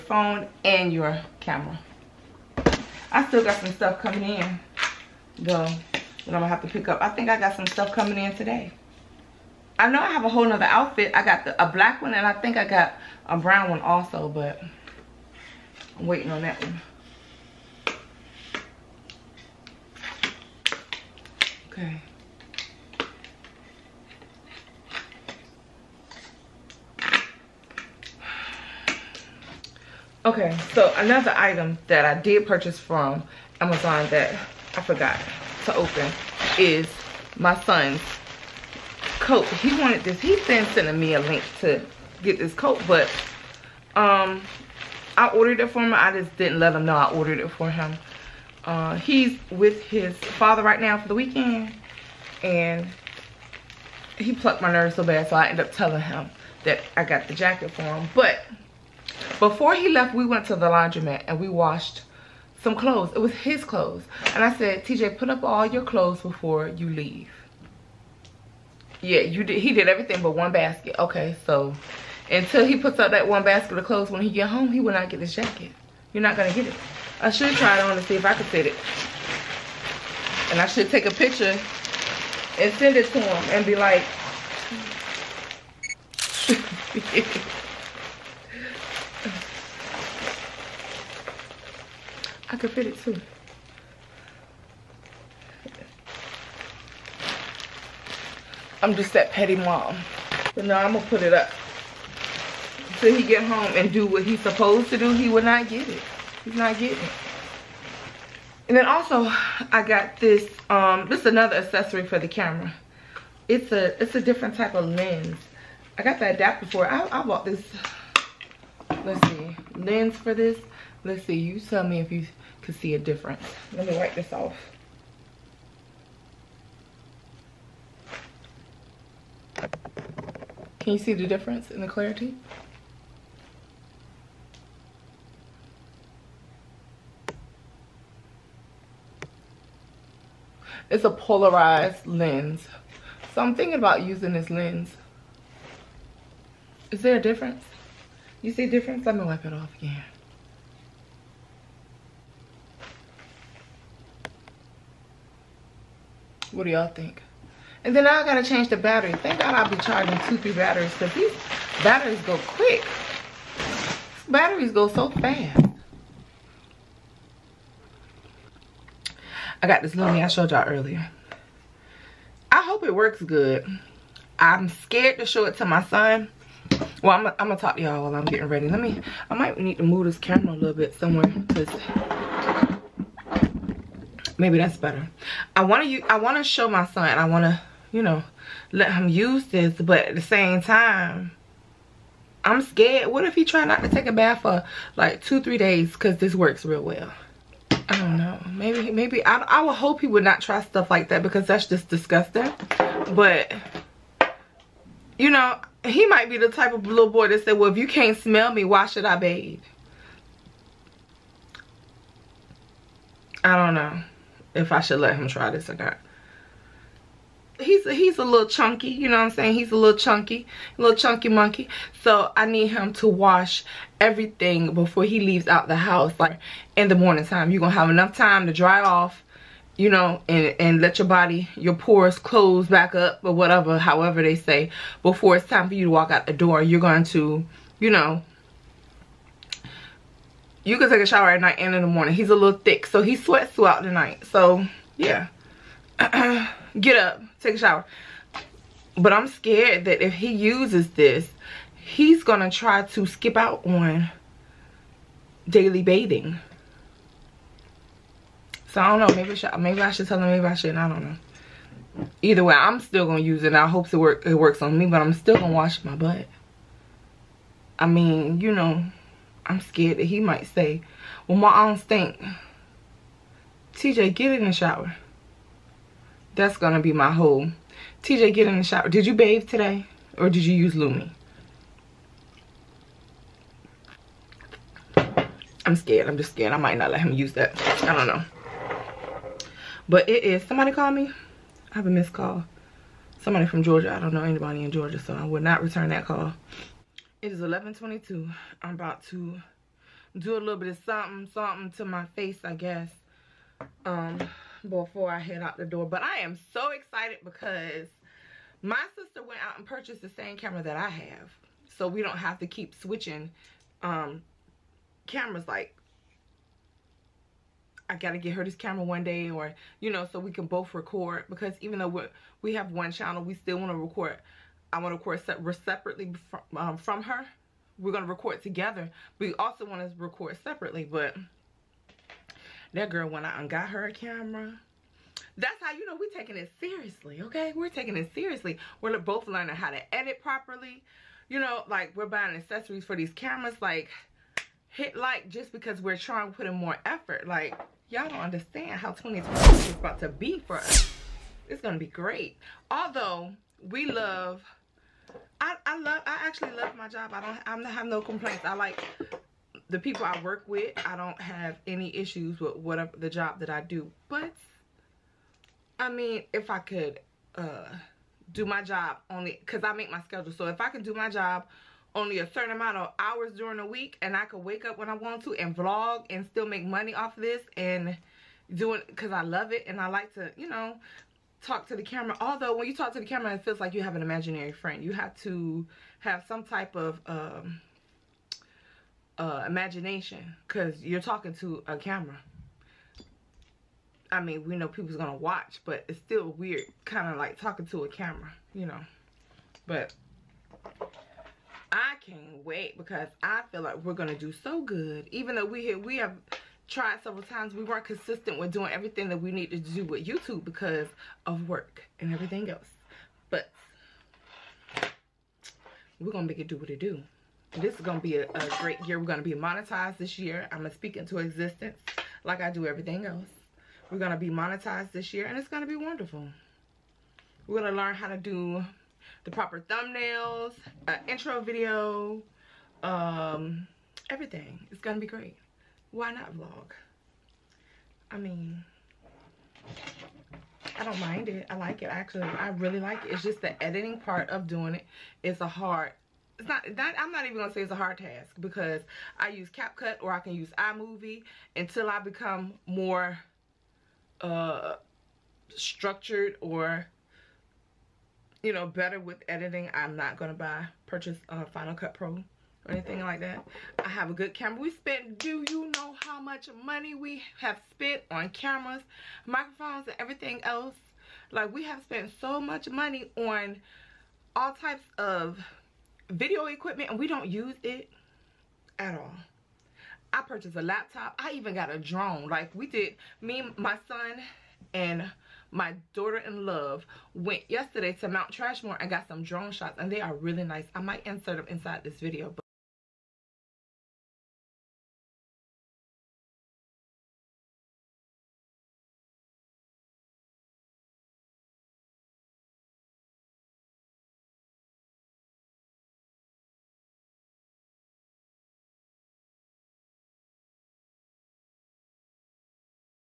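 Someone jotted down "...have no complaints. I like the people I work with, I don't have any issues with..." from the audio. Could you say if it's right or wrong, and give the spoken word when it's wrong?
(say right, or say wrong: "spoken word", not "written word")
right.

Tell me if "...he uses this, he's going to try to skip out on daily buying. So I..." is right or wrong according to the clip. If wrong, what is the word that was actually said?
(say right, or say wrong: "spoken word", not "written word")
wrong: "bathing", not "buying".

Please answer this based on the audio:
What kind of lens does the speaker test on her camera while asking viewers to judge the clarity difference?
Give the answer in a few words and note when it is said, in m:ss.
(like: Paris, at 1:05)
Polarized lens, at 2:21.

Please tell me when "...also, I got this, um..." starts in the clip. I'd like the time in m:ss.
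1:48.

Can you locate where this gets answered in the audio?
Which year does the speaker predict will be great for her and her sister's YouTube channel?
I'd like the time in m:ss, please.
5:48.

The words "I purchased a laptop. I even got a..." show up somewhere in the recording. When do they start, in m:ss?
8:00.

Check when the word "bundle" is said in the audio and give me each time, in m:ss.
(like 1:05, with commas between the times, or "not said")
not said.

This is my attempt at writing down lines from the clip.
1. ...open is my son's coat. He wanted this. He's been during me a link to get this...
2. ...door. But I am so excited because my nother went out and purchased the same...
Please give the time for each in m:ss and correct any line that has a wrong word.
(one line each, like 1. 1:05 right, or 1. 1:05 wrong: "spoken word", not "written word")
1. 0:35 wrong: "sending", not "during"
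2. 5:05 wrong: "sister", not "nother".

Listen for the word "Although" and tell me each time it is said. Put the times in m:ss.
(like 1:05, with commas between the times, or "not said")
5:52, 6:22.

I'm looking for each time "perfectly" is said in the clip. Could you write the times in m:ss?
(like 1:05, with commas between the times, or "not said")
not said.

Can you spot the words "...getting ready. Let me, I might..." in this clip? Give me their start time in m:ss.
2:58.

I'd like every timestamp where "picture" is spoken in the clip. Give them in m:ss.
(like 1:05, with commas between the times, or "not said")
1:21.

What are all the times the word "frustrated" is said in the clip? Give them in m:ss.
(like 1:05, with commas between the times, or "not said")
not said.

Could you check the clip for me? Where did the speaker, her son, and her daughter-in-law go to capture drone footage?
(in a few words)
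Mount Trashmore.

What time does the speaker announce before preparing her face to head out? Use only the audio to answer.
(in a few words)
11:22.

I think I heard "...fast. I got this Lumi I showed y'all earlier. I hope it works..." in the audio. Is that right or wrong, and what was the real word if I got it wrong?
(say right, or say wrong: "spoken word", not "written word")
right.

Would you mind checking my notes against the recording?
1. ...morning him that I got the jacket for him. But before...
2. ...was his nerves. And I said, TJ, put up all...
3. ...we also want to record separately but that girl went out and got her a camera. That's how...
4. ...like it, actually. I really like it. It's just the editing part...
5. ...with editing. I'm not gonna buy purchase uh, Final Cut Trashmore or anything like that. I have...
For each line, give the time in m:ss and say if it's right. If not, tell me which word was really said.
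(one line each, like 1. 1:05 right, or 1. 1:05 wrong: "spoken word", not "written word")
1. 0:55 wrong: "telling", not "morning"
2. 1:03 wrong: "clothes", not "nerves"
3. 5:29 right
4. 7:21 right
5. 7:38 wrong: "Pro", not "Trashmore".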